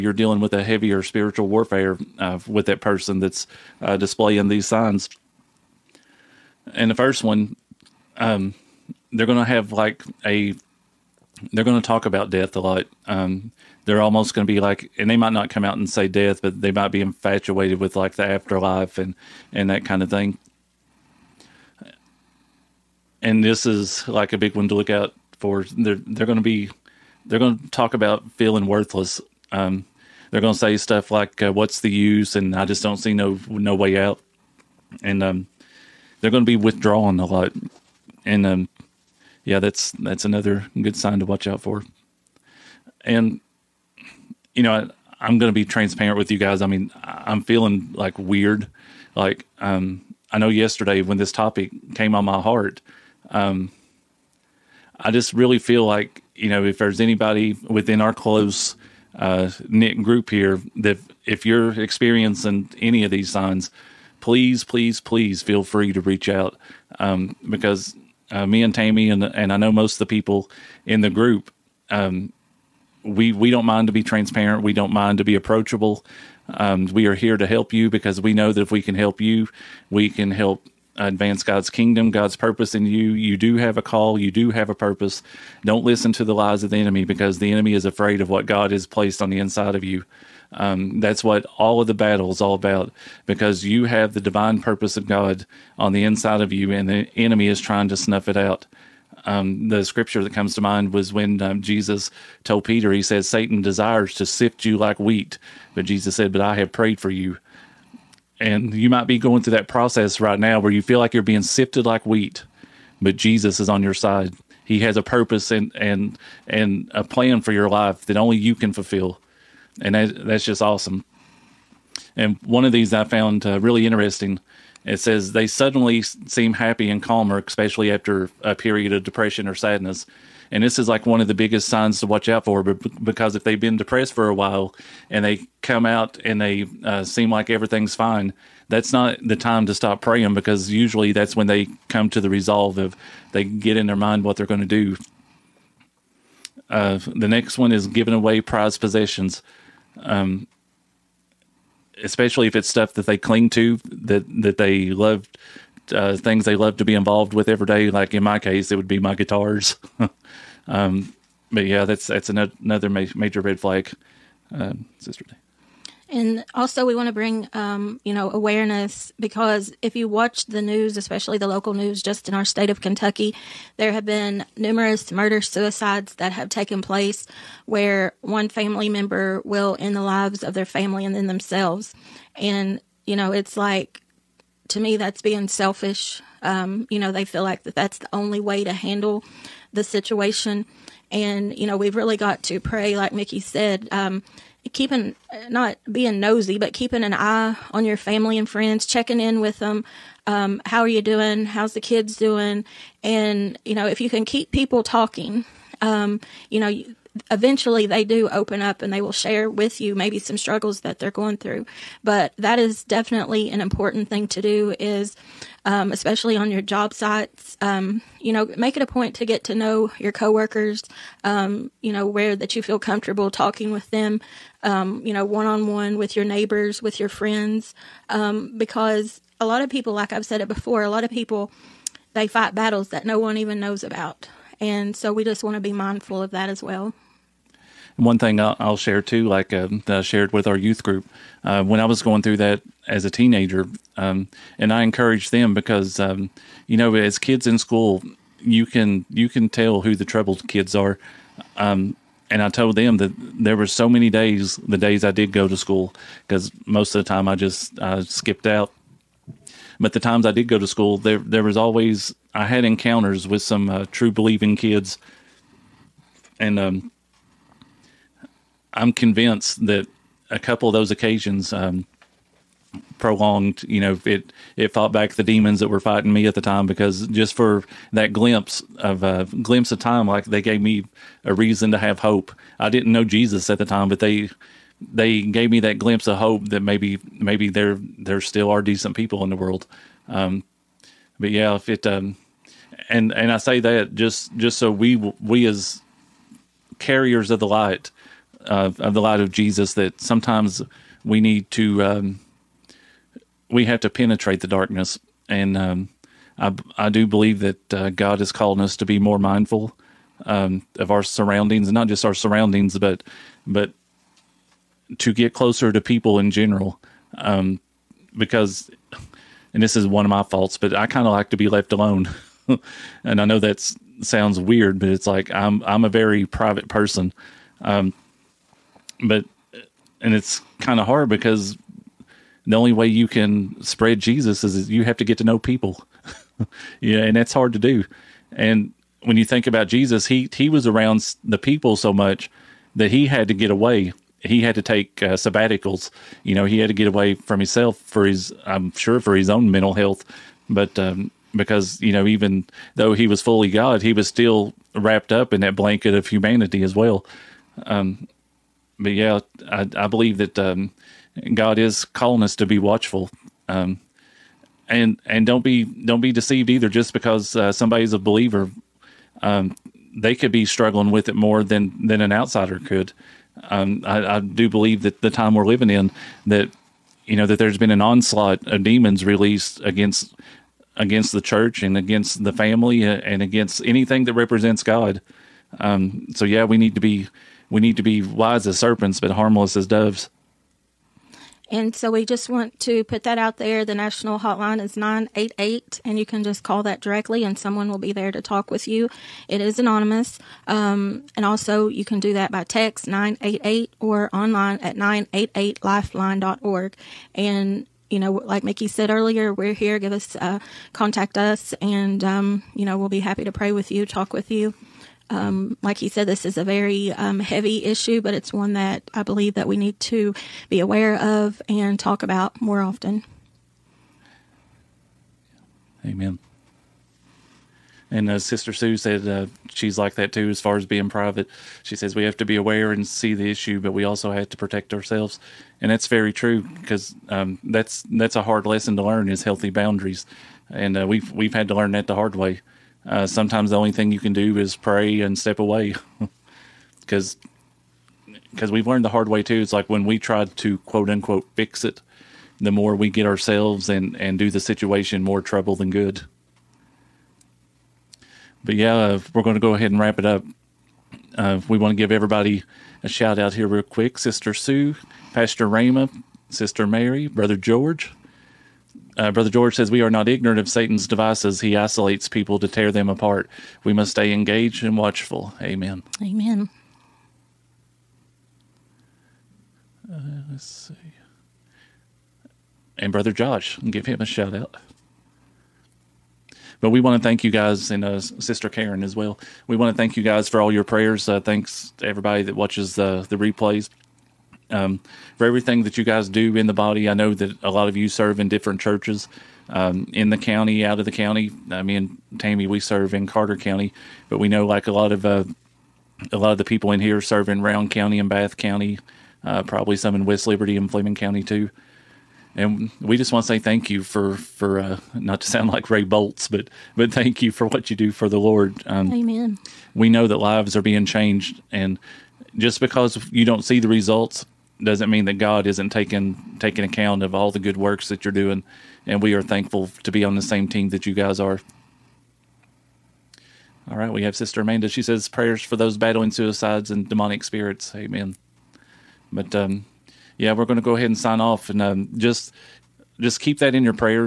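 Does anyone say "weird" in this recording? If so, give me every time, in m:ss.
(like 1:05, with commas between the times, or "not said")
0:48, 5:24.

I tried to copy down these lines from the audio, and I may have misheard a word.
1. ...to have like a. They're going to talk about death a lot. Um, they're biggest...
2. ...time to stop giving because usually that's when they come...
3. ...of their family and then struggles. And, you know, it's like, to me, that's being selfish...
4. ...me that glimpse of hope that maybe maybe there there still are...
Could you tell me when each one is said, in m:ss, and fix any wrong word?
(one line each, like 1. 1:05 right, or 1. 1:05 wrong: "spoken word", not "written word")
1. 0:09 wrong: "almost", not "biggest"
2. 2:19 wrong: "praying", not "giving"
3. 3:00 wrong: "themselves", not "struggles"
4. 4:45 right.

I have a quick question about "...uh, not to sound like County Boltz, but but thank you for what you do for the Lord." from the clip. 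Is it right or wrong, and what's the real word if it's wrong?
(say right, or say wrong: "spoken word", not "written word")
wrong: "Ray", not "County".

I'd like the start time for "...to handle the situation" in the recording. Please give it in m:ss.
3:08.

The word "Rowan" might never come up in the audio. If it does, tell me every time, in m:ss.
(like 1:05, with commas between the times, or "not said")
8:27.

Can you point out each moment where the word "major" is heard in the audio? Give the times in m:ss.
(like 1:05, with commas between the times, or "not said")
2:42.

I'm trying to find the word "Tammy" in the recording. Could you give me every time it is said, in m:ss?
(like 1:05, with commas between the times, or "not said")
1:08, 8:22.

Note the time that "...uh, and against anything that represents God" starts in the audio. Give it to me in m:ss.
6:22.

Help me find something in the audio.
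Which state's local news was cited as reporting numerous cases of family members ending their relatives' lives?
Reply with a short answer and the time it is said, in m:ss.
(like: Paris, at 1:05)
Kentucky, at 2:52.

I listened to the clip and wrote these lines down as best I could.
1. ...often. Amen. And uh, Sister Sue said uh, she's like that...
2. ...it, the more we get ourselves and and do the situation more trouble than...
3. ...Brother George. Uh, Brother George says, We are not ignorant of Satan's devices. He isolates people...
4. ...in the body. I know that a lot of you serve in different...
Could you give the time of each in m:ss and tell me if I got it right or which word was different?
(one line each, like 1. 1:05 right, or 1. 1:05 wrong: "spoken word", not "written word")
1. 7:02 right
2. 7:31 right
3. 7:47 right
4. 8:16 right.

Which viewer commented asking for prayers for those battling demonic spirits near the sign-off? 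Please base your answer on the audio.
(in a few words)
Sister Amanda.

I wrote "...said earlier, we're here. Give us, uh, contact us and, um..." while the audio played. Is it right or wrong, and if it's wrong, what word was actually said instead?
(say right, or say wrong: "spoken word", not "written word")
right.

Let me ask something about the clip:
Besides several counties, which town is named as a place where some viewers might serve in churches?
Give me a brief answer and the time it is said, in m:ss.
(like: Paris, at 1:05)
West Liberty, at 8:30.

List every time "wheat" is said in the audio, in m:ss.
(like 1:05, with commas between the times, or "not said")
1:44, 1:52.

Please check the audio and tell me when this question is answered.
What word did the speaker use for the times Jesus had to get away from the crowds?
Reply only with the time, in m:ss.
5:45.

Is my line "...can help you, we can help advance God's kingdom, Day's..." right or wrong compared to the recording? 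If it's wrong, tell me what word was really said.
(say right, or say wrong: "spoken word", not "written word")
wrong: "God", not "Day".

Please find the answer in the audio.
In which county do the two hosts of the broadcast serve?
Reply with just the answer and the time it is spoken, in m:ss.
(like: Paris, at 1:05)
Carter County, at 8:23.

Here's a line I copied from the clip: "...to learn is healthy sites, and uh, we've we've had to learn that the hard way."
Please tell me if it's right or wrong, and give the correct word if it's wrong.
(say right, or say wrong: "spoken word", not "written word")
wrong: "boundaries", not "sites".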